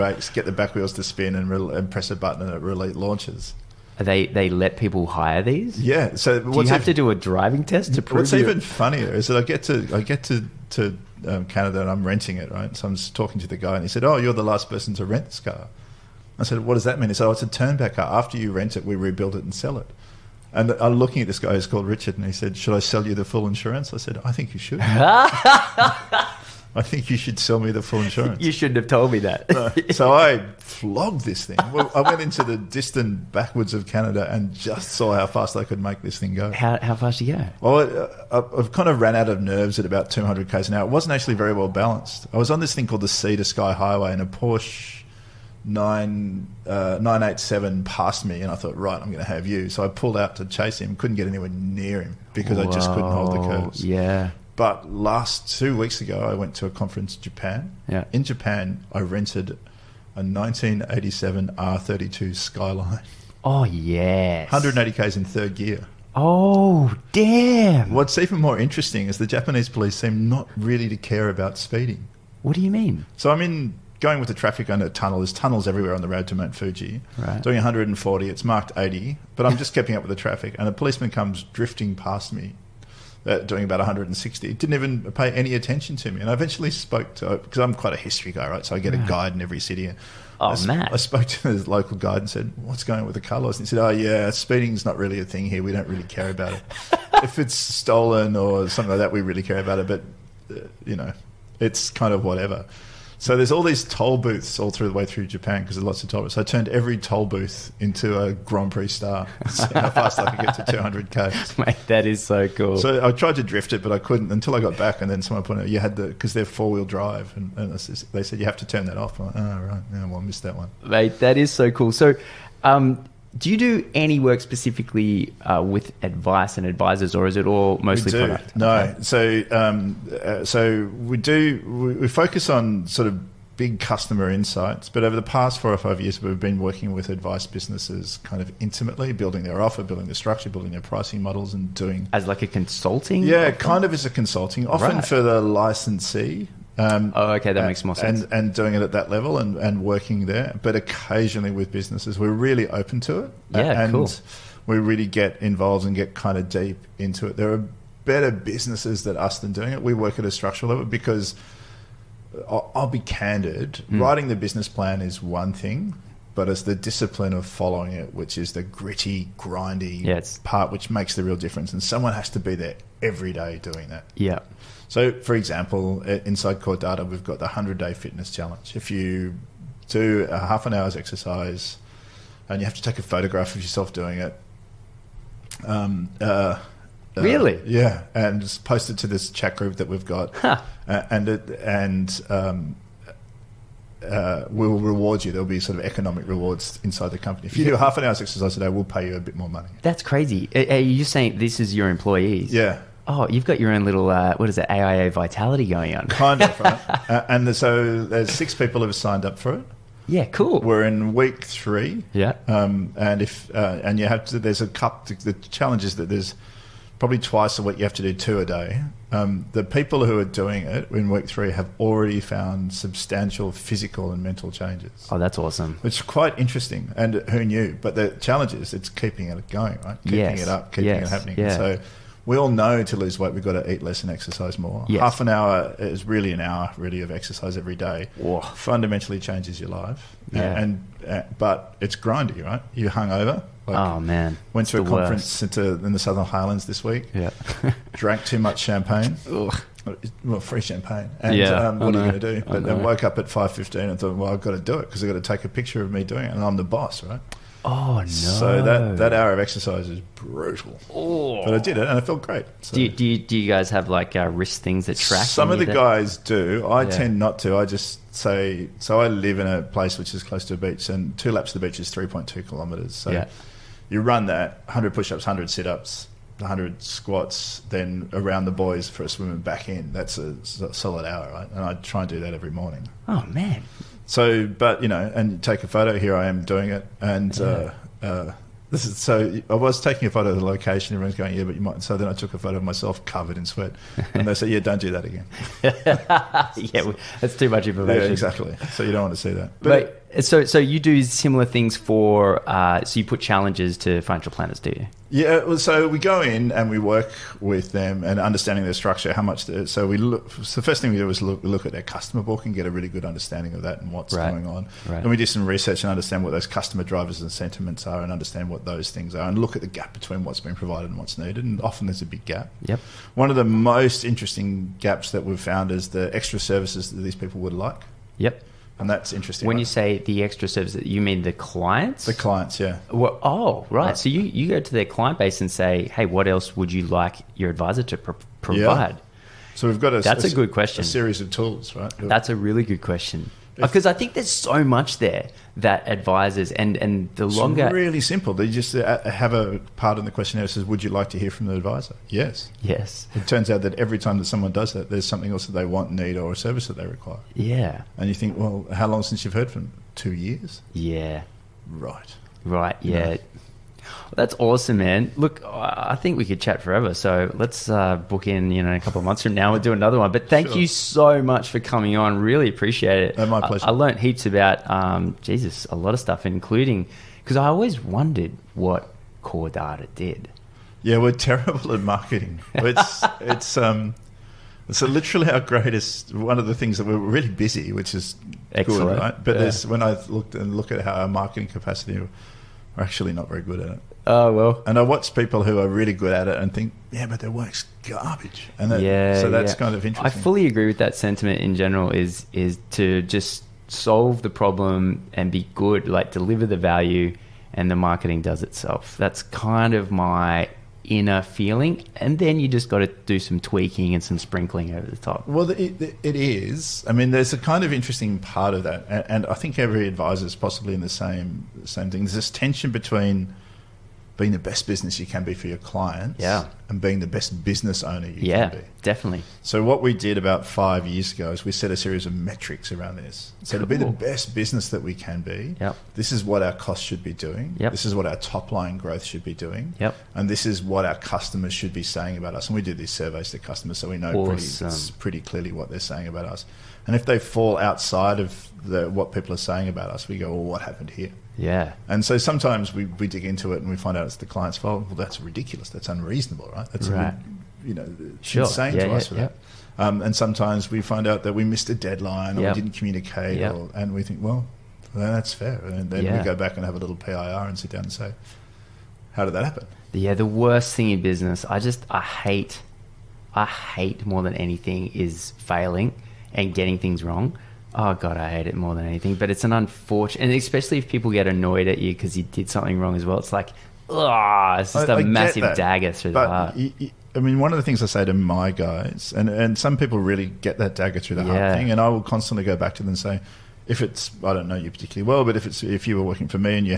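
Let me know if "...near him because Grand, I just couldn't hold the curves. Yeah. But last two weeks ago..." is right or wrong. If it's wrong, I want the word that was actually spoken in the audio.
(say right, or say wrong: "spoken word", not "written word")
wrong: "Whoa", not "Grand".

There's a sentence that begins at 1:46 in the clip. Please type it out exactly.
So I turned every toll booth into a Grand Prix star.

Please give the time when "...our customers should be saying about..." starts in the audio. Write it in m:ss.
7:20.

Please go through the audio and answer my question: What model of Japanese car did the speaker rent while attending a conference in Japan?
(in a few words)
R32 Skyline.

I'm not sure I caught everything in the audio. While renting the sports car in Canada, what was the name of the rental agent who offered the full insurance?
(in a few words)
Richard.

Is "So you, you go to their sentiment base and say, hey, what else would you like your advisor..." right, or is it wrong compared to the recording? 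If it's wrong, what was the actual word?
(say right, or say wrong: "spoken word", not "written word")
wrong: "client", not "sentiment".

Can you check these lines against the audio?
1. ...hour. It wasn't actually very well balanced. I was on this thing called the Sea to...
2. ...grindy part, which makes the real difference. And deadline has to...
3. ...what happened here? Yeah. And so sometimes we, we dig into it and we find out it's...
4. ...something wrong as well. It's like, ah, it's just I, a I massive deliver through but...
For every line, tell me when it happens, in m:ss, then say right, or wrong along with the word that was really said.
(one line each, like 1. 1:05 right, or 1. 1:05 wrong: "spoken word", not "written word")
1. 0:40 right
2. 2:49 wrong: "someone", not "deadline"
3. 7:30 right
4. 8:02 wrong: "dagger", not "deliver".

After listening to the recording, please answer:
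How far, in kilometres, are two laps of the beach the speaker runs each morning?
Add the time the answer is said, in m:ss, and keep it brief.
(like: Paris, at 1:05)
3.2 kilometres, at 4:31.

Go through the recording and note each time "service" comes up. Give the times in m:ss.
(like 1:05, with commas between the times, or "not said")
5:26, 5:30, 5:56.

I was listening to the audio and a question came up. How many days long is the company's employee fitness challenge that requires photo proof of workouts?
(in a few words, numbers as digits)
100.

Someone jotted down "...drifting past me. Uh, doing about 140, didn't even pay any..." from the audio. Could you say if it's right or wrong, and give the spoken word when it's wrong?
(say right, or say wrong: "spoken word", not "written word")
wrong: "160", not "140".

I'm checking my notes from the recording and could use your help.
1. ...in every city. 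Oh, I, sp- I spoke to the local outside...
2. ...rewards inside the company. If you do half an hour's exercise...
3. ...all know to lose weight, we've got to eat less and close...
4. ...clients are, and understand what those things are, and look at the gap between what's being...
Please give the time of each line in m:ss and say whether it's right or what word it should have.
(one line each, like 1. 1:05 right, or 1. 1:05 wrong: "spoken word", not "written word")
1. 1:29 wrong: "guide", not "outside"
2. 3:16 right
3. 3:52 wrong: "exercise", not "close"
4. 5:17 wrong: "sentiments", not "clients".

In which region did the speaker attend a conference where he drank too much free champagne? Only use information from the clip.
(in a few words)
Southern Highlands.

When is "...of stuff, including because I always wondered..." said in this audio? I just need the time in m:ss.
6:15.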